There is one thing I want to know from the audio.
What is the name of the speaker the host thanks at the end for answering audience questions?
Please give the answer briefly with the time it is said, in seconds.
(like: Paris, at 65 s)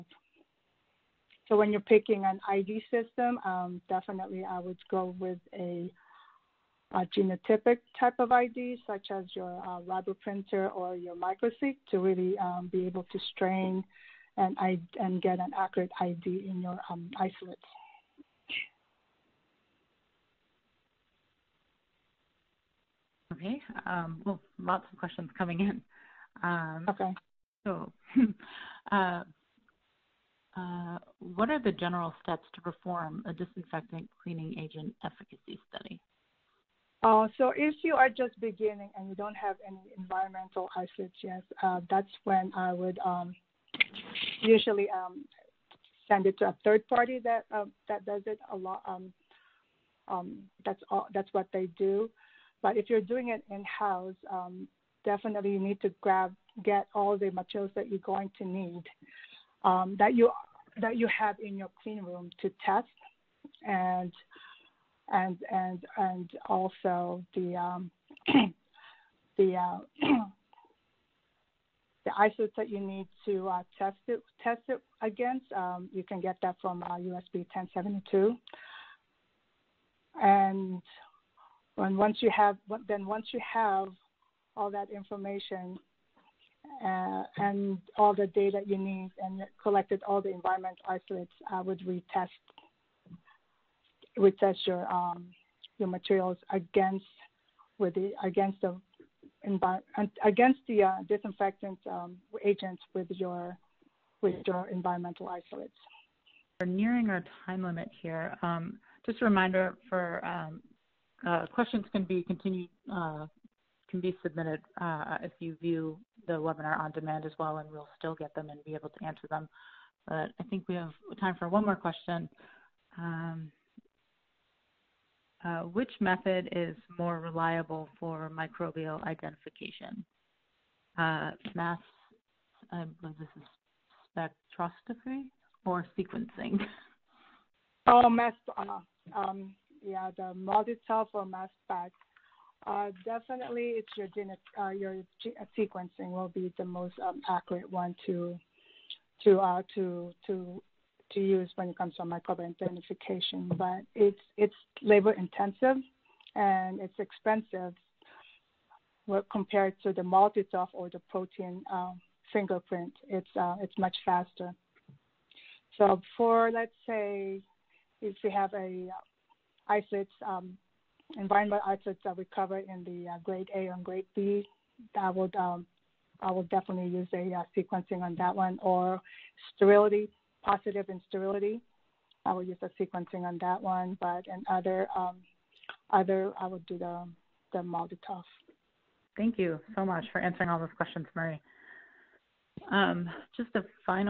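Marie, at 191 s.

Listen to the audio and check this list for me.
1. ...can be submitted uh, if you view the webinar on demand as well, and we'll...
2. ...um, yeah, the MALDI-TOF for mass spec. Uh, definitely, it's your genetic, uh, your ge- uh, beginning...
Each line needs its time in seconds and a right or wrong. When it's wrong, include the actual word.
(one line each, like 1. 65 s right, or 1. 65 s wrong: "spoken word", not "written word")
1. 113 s right
2. 139 s wrong: "sequencing", not "beginning".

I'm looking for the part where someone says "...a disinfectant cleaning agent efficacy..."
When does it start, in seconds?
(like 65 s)
33 s.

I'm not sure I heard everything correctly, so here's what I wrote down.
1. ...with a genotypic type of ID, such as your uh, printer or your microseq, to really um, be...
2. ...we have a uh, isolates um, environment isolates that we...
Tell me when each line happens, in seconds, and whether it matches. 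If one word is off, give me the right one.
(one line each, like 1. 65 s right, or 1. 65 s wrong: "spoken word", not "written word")
1. 5 s right
2. 168 s right.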